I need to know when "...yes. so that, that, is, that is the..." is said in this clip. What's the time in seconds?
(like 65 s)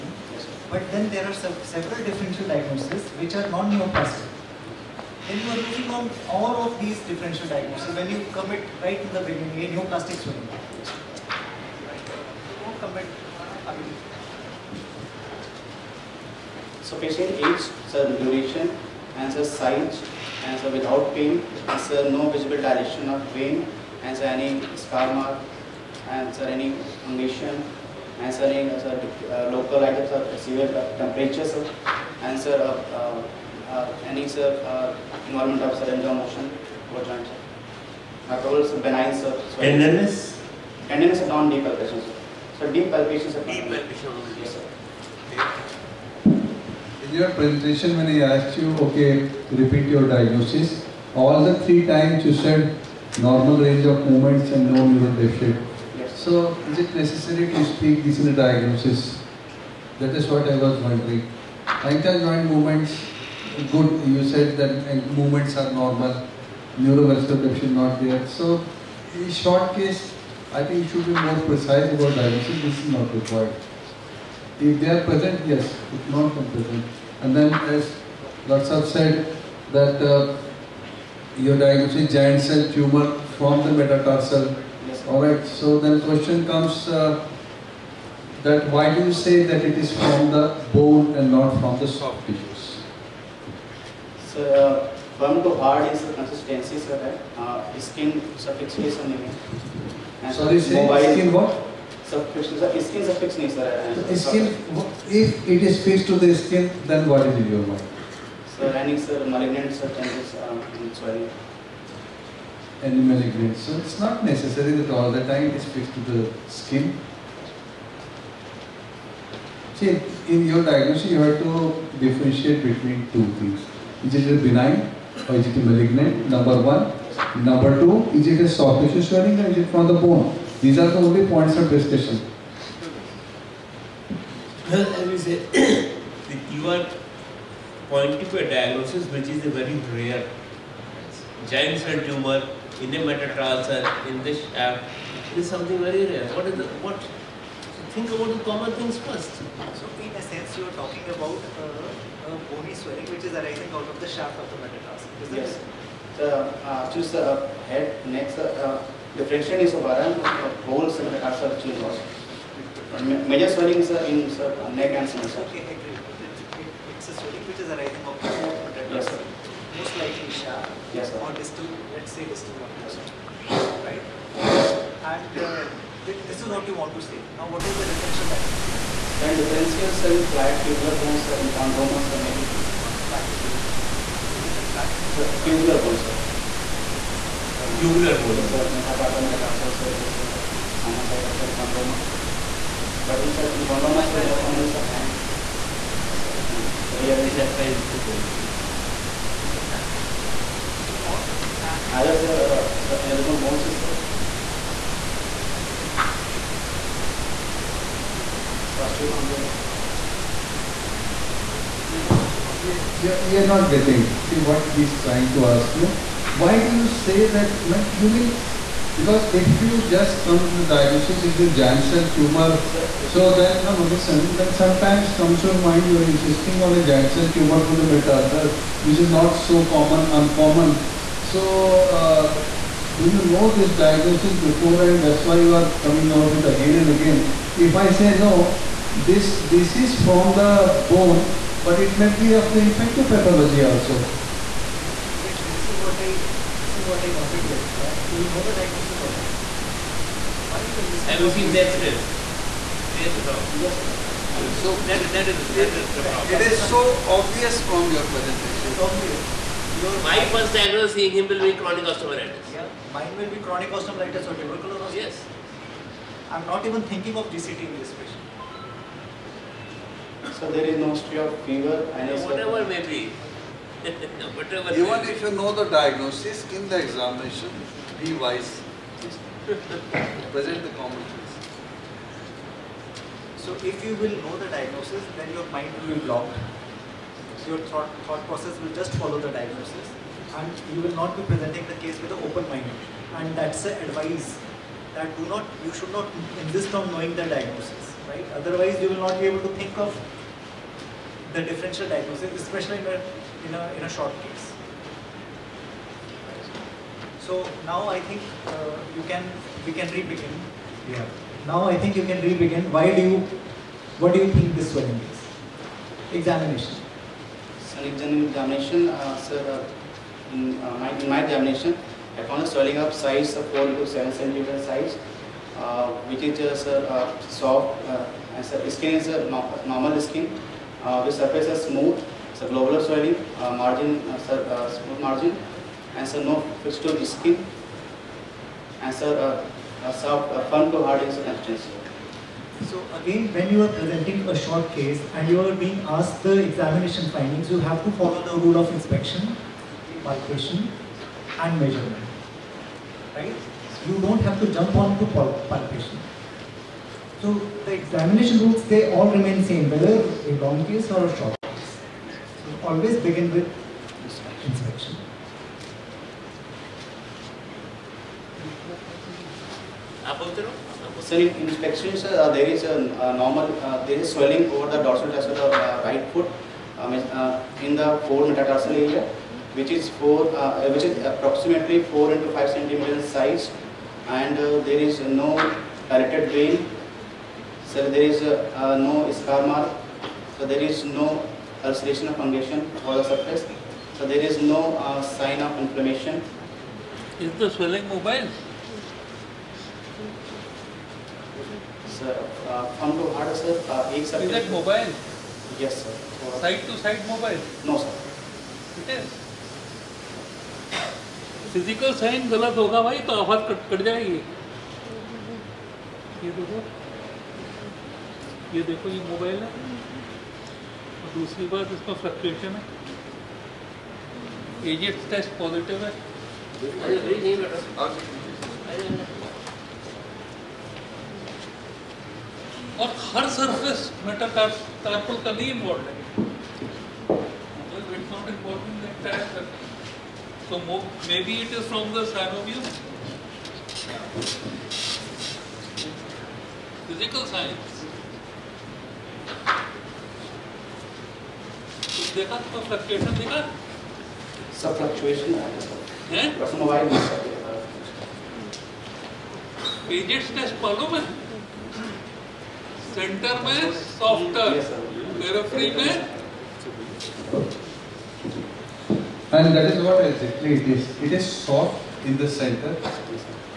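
253 s.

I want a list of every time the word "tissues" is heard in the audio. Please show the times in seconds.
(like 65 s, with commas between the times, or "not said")
92 s, 128 s.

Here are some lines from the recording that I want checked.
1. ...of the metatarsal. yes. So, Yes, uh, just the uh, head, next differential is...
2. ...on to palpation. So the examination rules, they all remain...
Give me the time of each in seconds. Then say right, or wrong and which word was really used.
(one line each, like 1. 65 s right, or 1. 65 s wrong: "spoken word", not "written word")
1. 154 s wrong: "The", not "Yes"
2. 354 s right.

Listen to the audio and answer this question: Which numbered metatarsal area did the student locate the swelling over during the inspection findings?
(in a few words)
4.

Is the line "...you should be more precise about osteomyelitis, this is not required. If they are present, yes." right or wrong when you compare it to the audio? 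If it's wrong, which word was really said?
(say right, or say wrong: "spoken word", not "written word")
wrong: "diagnosis", not "osteomyelitis".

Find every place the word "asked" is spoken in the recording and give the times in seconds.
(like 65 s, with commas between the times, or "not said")
48 s, 345 s.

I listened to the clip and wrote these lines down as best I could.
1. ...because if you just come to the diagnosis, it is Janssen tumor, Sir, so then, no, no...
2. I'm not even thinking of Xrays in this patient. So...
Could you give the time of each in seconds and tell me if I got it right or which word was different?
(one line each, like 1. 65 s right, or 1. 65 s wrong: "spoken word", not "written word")
1. 218 s right
2. 266 s wrong: "GCT", not "Xrays".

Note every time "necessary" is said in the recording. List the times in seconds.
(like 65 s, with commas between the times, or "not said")
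56 s, 114 s.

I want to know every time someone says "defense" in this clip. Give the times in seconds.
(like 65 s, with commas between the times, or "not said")
not said.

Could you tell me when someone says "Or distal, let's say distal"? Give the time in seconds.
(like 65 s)
171 s.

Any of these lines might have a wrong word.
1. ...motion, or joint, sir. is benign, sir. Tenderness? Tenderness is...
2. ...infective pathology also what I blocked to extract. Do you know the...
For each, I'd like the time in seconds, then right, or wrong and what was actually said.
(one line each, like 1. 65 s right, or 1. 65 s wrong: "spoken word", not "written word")
1. 36 s right
2. 242 s wrong: "wanted", not "blocked".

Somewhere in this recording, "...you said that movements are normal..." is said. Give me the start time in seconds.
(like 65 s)
64 s.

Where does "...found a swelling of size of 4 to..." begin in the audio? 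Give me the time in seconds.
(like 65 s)
322 s.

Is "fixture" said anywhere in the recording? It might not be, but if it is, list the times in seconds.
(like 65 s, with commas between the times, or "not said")
336 s.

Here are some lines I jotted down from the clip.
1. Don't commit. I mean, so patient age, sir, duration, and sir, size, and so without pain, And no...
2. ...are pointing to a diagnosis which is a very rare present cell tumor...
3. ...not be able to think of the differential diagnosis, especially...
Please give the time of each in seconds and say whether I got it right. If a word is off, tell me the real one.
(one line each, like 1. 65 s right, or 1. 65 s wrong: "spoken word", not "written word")
1. 11 s wrong: "Answer", not "And"
2. 136 s wrong: "giant", not "present"
3. 299 s right.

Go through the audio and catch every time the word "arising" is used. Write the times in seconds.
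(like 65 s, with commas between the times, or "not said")
153 s, 167 s.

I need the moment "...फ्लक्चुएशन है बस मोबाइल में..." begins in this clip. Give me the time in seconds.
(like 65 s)
454 s.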